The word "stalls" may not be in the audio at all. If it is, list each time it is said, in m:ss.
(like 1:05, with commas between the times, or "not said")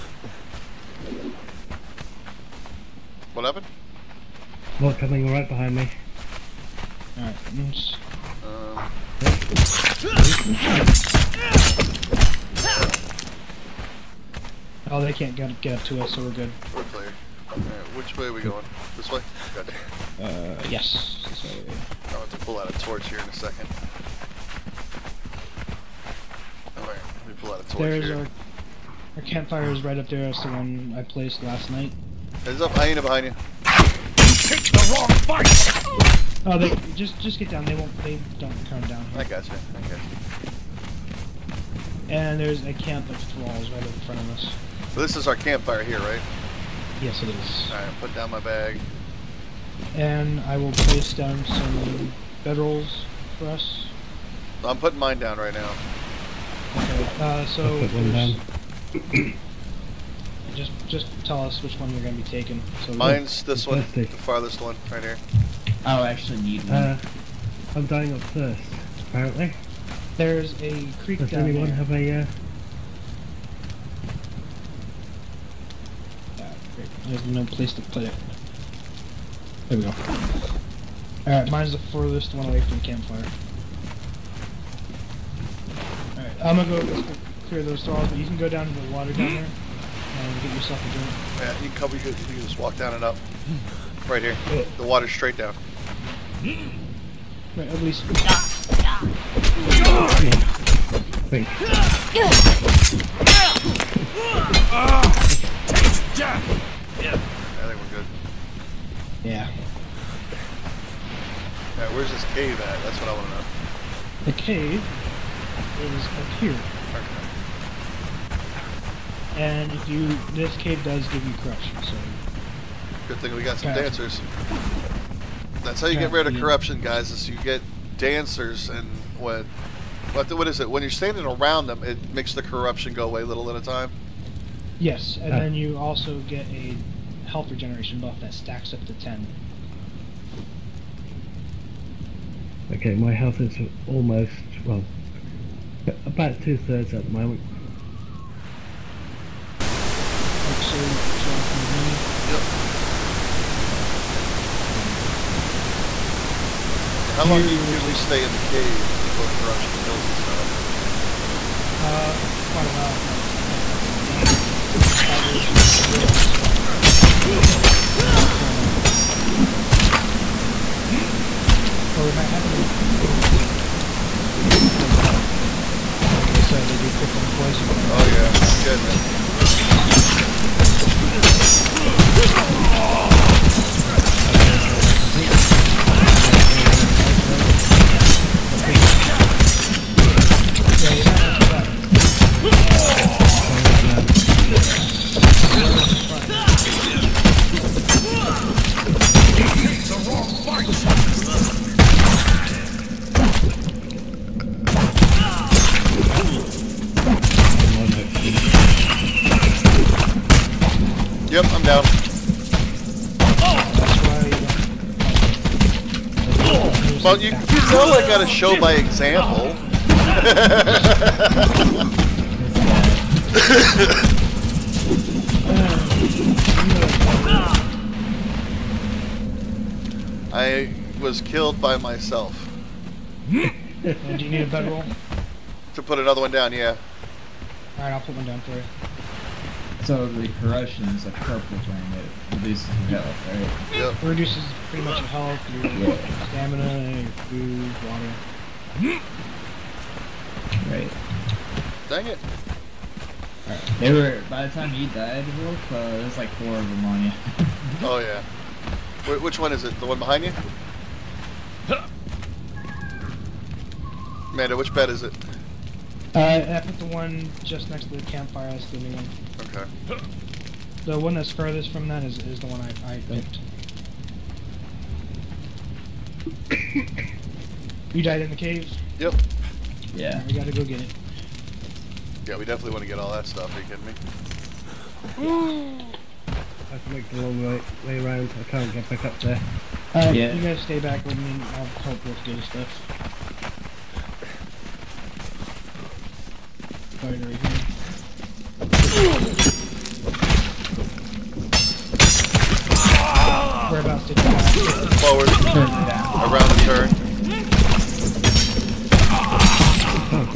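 1:27.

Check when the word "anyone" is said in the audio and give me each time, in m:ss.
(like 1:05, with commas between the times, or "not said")
1:11.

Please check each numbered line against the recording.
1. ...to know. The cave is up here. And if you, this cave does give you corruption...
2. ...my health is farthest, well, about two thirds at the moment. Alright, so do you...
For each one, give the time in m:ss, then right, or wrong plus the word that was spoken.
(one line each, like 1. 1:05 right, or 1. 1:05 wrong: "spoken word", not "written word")
1. 1:53 right
2. 2:22 wrong: "almost", not "farthest".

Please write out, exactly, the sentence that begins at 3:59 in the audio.
So the corruption is a purple thing that reduces your health, right?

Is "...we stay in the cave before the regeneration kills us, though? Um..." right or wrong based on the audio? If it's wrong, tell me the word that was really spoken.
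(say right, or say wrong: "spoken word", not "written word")
wrong: "corruption", not "regeneration".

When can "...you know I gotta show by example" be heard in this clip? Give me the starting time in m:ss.
3:37.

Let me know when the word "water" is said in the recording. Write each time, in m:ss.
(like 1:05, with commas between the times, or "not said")
1:28, 1:34, 4:07.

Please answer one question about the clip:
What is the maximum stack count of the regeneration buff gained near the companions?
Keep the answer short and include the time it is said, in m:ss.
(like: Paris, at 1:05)
10, at 2:18.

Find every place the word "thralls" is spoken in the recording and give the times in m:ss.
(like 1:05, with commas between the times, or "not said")
0:43.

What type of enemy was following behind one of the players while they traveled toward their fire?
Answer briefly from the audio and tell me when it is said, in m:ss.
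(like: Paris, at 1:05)
Hyena, at 0:32.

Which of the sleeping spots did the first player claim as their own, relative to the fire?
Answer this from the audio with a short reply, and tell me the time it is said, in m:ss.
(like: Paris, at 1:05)
The farthest one, at 1:03.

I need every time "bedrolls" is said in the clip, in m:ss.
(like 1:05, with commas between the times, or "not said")
0:52, 3:54.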